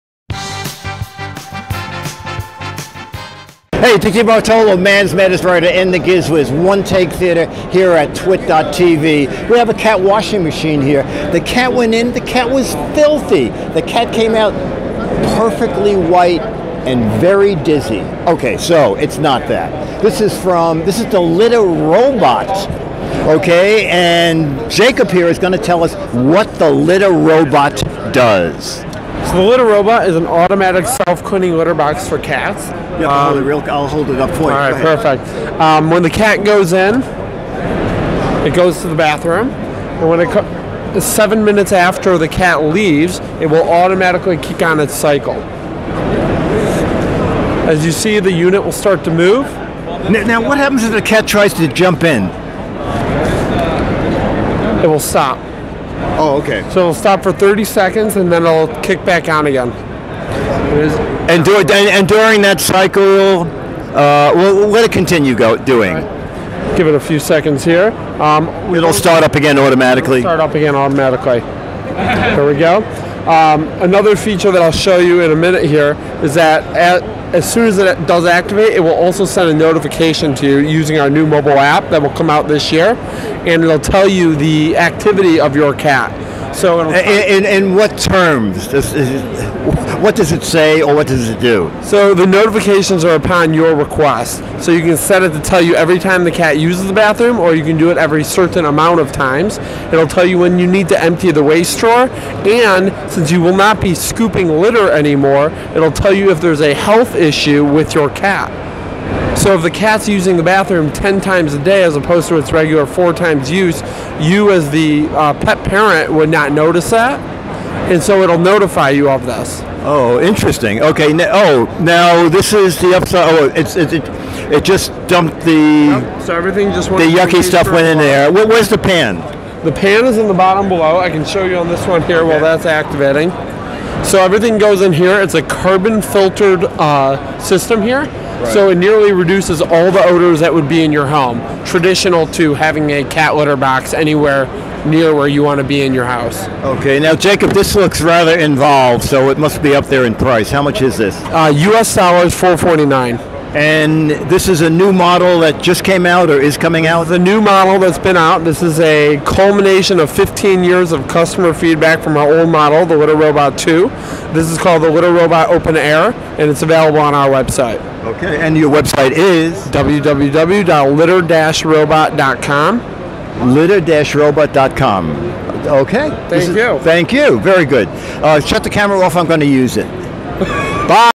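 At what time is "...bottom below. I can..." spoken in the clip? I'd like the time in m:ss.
2:10.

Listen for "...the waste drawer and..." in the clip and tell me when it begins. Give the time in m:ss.
1:41.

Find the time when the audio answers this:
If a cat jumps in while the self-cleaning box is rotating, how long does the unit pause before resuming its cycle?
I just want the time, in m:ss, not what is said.
0:57.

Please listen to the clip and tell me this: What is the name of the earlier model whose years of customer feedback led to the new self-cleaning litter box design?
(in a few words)
Litter Robot 2.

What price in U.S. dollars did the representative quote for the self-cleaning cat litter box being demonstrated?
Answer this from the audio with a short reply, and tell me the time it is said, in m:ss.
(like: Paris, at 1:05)
$449, at 2:32.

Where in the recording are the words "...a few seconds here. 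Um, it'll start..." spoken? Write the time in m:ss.
1:06.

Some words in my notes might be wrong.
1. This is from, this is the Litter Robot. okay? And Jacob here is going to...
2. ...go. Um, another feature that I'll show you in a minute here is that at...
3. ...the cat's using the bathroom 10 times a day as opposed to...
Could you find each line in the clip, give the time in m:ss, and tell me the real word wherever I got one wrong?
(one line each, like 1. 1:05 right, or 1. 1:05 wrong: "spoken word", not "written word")
1. 0:20 right
2. 1:12 right
3. 1:49 right.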